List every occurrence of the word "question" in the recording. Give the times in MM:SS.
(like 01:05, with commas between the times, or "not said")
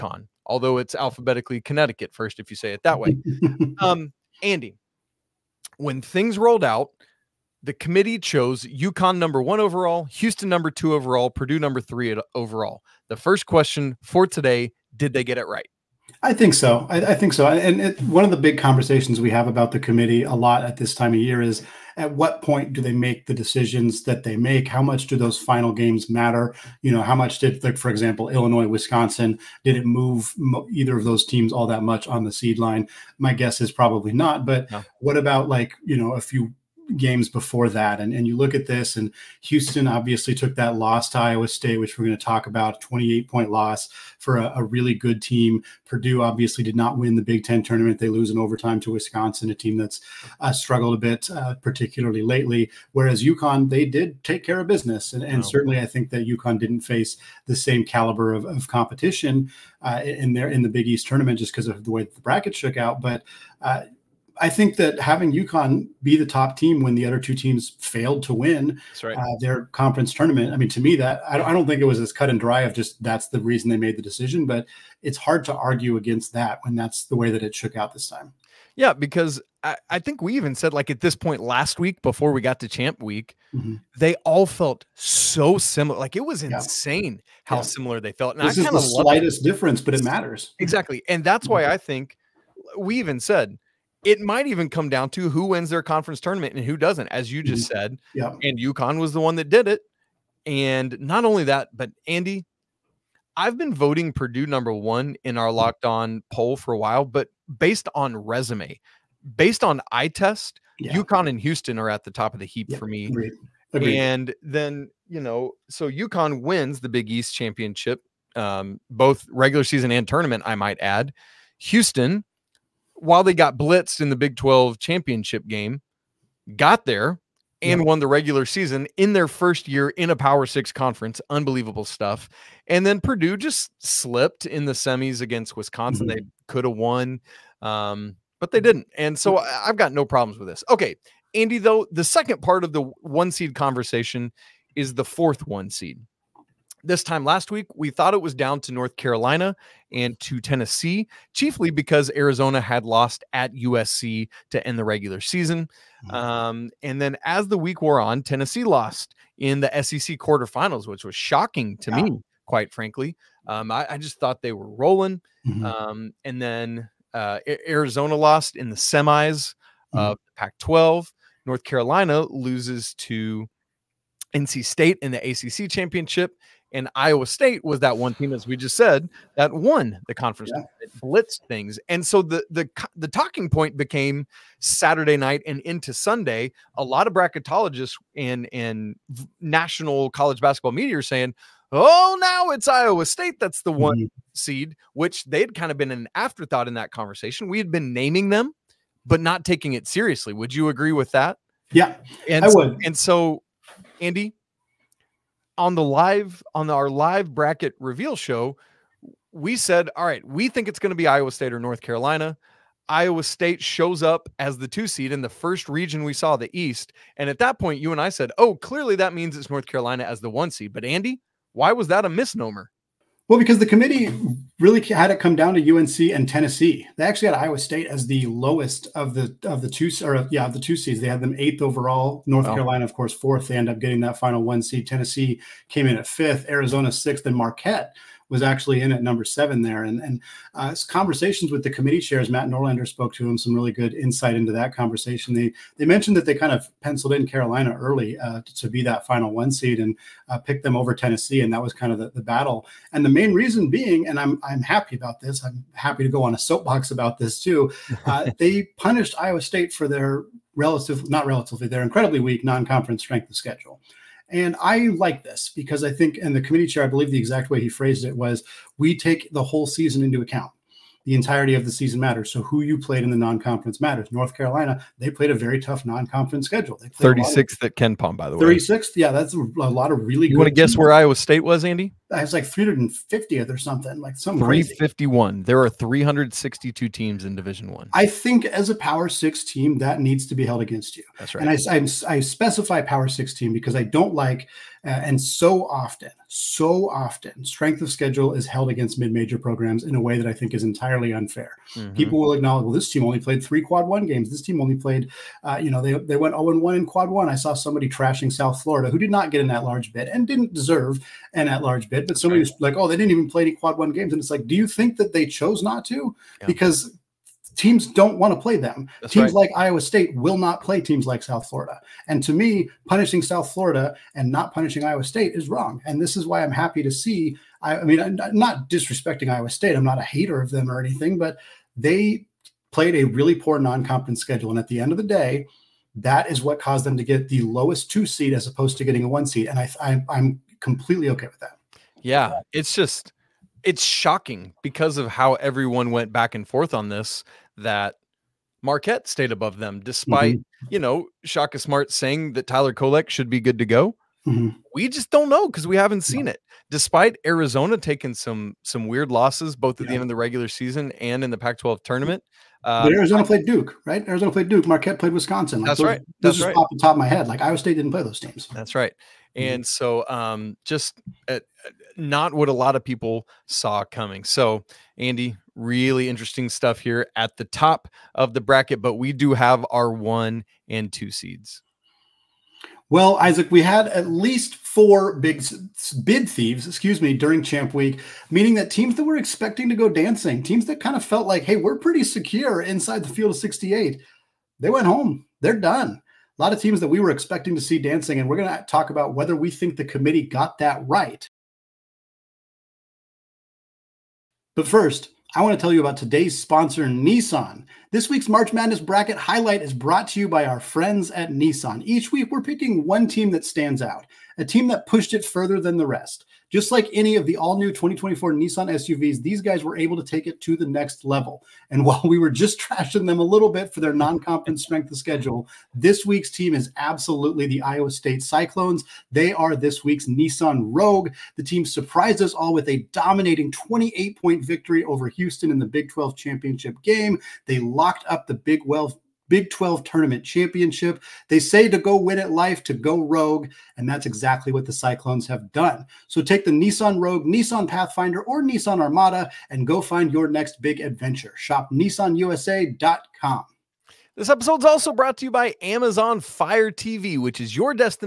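00:13.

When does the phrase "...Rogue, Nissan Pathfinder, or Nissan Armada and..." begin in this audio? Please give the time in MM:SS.
07:26.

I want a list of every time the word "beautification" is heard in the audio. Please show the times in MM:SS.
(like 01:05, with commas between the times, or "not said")
not said.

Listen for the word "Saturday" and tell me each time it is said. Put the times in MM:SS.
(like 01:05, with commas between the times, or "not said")
03:04.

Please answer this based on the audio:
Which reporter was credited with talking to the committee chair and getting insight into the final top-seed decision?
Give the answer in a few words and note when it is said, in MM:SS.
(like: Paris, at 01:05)
Matt Norlander, at 04:02.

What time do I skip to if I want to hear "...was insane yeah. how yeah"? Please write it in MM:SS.
01:26.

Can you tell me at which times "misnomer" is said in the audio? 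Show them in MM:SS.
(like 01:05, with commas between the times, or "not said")
03:42.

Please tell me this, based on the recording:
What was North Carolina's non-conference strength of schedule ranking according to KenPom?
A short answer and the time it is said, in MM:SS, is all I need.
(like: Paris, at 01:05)
36th, at 04:36.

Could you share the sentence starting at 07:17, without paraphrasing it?
They locked up the Big 12 Big 12 tournament championship.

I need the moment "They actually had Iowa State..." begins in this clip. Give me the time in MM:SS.
03:46.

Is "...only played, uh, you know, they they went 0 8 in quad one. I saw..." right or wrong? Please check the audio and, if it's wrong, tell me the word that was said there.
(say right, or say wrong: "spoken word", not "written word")
wrong: "1", not "8".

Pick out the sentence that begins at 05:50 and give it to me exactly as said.
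you know Shaka Smart saying that Tyler Kolek should be good to go.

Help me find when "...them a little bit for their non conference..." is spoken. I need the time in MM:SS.
07:03.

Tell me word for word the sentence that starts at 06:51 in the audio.
Each week, we're picking one team that stands out, a team that pushed it further than the rest.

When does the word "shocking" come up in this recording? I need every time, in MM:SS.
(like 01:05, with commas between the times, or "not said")
02:41, 05:43.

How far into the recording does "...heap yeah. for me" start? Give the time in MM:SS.
01:52.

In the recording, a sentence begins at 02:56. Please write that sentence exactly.
And Iowa State was that one team, as we just said, that won the conference.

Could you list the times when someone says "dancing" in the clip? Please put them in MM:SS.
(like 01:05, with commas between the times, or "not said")
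06:29, 06:37.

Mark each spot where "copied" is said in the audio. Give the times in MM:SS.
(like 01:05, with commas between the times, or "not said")
not said.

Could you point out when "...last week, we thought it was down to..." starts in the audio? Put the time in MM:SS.
02:27.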